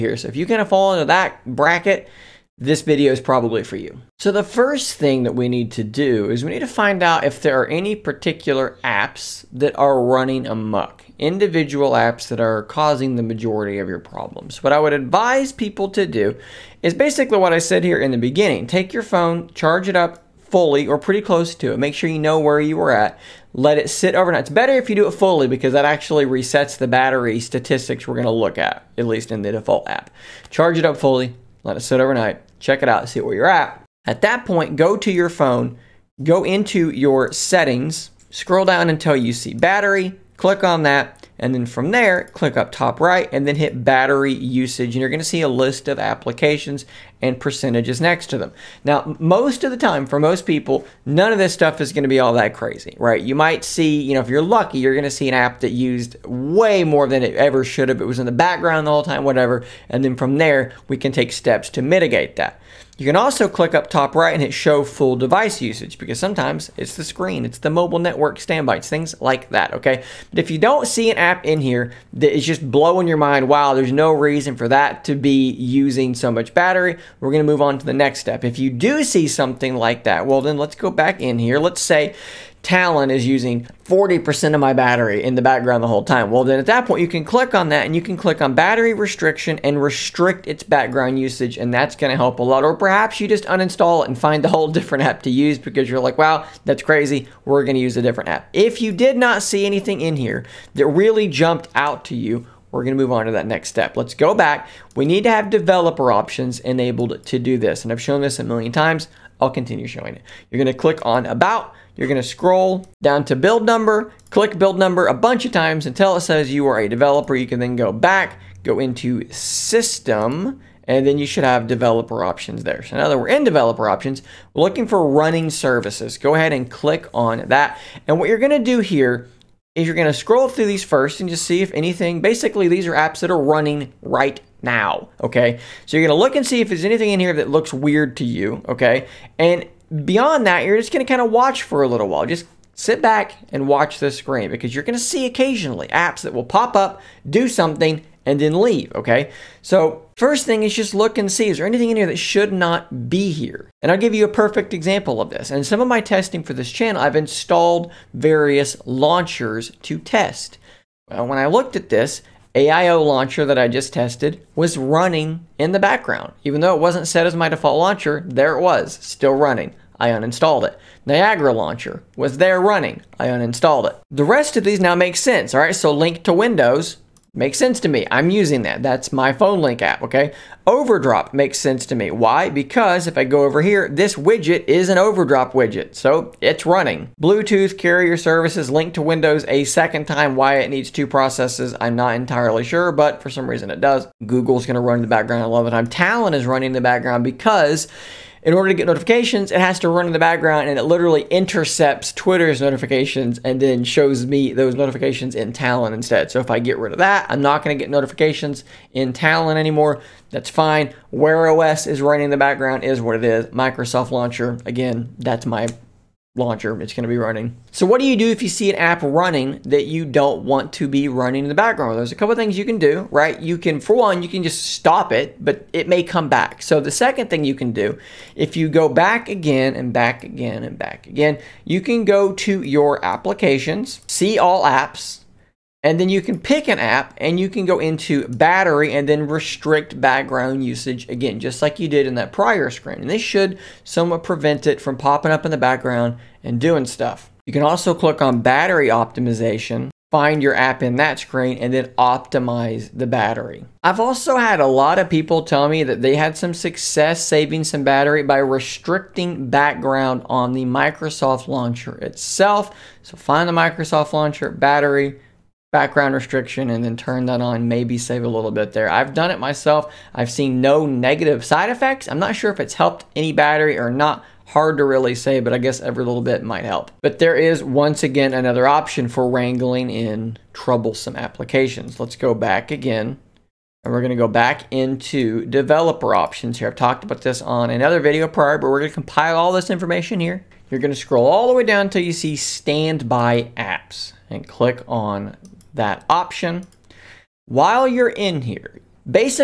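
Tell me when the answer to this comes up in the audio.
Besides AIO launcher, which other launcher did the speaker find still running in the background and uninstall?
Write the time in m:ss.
2:51.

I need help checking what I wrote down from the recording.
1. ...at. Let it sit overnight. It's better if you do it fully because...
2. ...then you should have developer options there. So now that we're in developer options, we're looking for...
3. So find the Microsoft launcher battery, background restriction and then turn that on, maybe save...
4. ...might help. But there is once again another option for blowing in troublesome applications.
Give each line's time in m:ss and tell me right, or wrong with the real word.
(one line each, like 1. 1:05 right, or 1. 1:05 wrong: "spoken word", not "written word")
1. 0:22 right
2. 2:01 right
3. 4:23 right
4. 4:36 wrong: "wrangling", not "blowing".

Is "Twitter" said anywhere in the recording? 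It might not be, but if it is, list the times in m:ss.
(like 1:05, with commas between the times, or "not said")
3:22.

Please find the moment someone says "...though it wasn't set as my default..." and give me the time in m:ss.
2:46.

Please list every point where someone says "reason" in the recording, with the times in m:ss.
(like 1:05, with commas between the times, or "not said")
1:14, 3:13.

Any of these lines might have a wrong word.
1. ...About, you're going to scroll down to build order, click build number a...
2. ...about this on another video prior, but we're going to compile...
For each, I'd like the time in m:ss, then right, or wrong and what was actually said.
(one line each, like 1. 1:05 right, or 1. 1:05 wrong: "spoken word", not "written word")
1. 1:51 wrong: "number", not "order"
2. 4:47 right.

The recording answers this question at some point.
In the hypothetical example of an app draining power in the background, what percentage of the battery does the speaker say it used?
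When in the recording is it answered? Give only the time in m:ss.
1:23.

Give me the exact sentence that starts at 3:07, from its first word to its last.
Bluetooth carrier services linked to Windows a second time.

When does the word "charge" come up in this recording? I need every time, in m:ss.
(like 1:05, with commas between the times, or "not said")
0:19, 0:30.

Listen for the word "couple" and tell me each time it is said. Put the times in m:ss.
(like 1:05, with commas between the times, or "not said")
3:42.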